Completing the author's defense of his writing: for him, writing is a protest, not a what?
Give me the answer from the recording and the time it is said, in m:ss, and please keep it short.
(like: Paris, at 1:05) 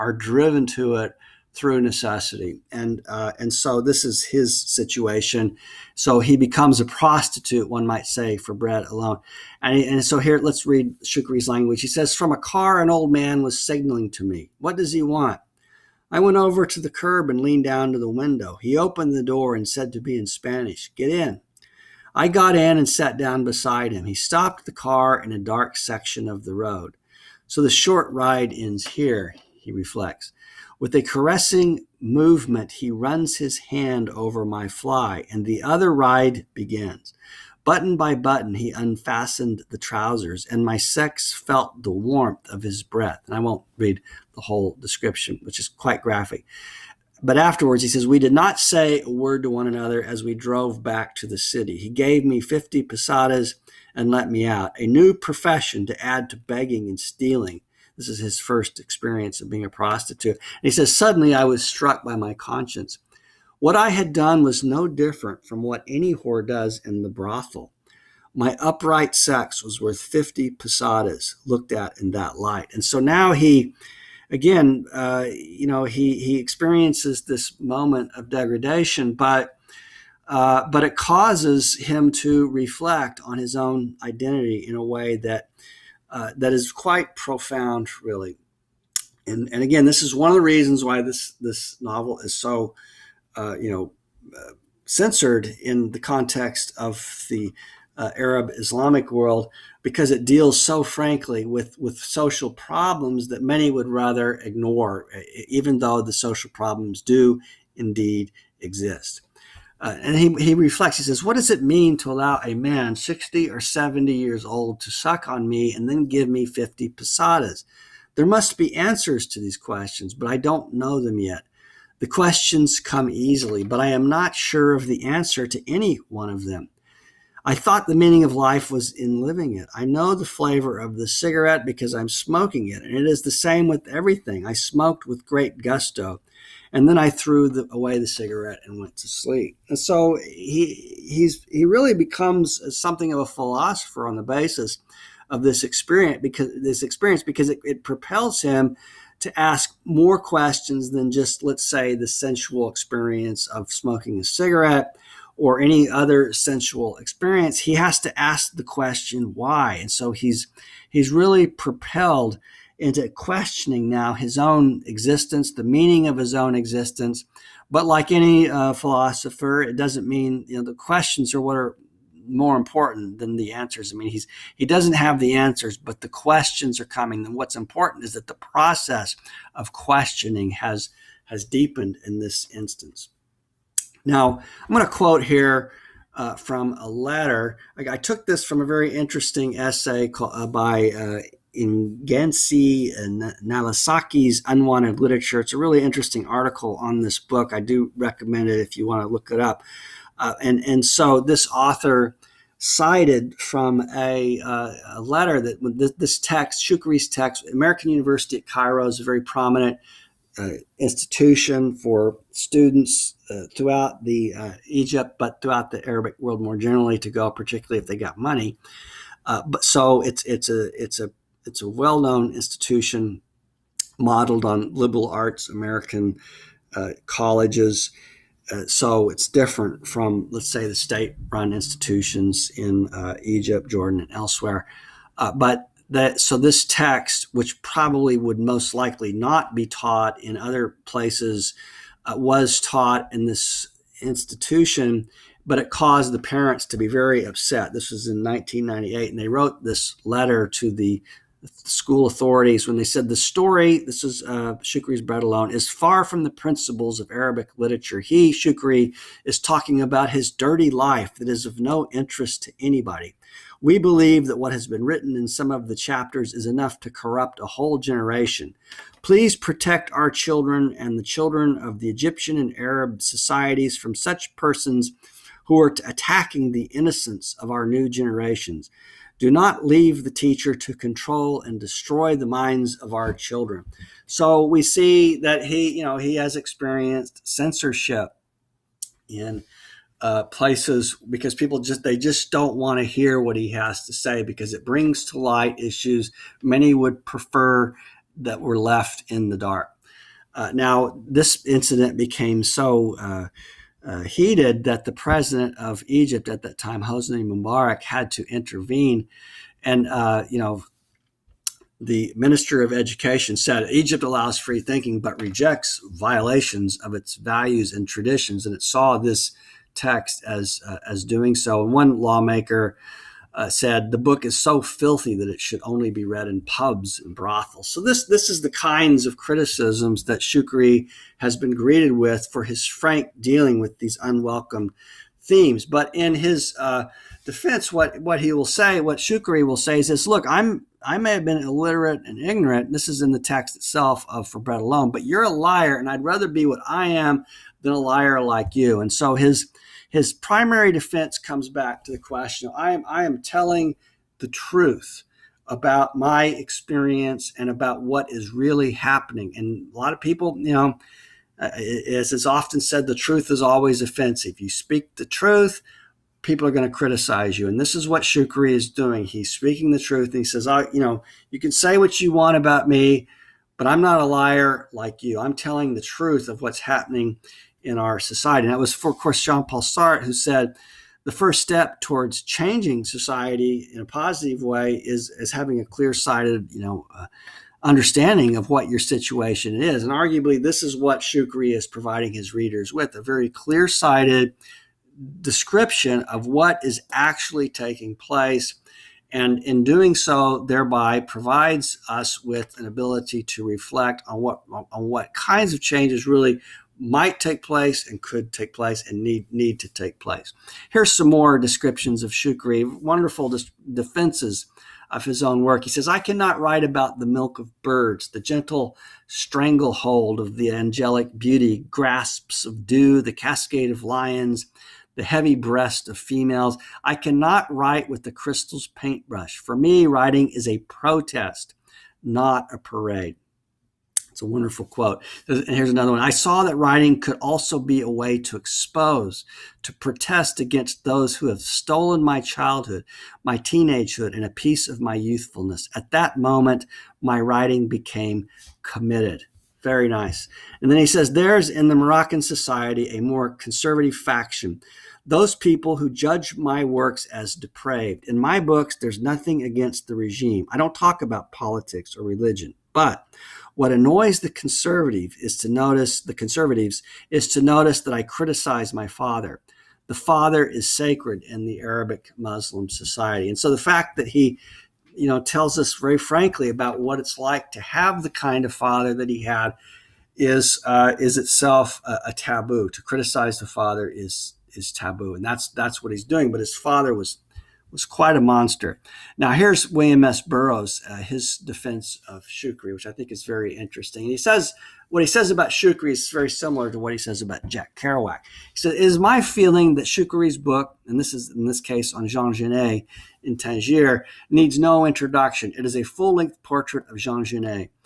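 A parade, at 7:12.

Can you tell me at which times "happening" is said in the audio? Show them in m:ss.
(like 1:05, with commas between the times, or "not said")
5:58, 6:16.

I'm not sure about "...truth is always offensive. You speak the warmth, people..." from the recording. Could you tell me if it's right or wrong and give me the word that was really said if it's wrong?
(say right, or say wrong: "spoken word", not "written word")
wrong: "truth", not "warmth".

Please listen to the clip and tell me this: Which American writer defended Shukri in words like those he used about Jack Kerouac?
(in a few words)
William S. Burroughs.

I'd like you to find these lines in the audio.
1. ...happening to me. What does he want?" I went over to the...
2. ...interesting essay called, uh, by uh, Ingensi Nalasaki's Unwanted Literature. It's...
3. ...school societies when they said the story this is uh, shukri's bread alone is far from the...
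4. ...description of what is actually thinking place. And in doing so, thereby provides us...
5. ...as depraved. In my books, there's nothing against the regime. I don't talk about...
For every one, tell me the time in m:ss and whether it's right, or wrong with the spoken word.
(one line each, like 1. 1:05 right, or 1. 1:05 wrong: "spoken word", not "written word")
1. 0:13 wrong: "signaling", not "happening"
2. 3:08 right
3. 4:11 wrong: "authorities", not "societies"
4. 6:35 wrong: "taking", not "thinking"
5. 7:37 right.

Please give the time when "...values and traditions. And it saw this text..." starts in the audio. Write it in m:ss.
5:17.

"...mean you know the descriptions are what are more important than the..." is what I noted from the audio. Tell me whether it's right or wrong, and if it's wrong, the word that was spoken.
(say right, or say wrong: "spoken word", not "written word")
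wrong: "questions", not "descriptions".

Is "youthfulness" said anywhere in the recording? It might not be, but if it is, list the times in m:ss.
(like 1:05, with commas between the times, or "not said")
7:24.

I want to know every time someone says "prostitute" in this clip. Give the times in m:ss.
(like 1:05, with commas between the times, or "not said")
0:06, 0:59.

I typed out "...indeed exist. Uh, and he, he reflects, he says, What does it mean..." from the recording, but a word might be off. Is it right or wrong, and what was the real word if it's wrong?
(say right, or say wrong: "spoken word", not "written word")
right.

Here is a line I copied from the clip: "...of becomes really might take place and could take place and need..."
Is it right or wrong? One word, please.
wrong.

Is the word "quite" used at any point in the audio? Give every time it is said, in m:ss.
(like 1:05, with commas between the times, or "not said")
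0:45, 1:26, 8:07.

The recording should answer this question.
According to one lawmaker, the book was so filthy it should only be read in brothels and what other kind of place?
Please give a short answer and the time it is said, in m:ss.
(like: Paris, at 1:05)
Pubs, at 5:26.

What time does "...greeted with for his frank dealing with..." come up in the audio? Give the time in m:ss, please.
5:31.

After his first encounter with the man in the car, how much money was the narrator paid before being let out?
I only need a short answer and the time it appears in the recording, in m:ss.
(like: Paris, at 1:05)
50 pesetas, at 0:51.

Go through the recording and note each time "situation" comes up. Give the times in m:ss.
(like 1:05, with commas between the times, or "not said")
0:04, 6:28.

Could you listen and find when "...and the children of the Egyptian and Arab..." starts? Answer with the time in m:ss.
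4:30.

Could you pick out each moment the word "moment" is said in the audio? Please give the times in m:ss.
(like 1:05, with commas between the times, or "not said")
1:17, 7:26.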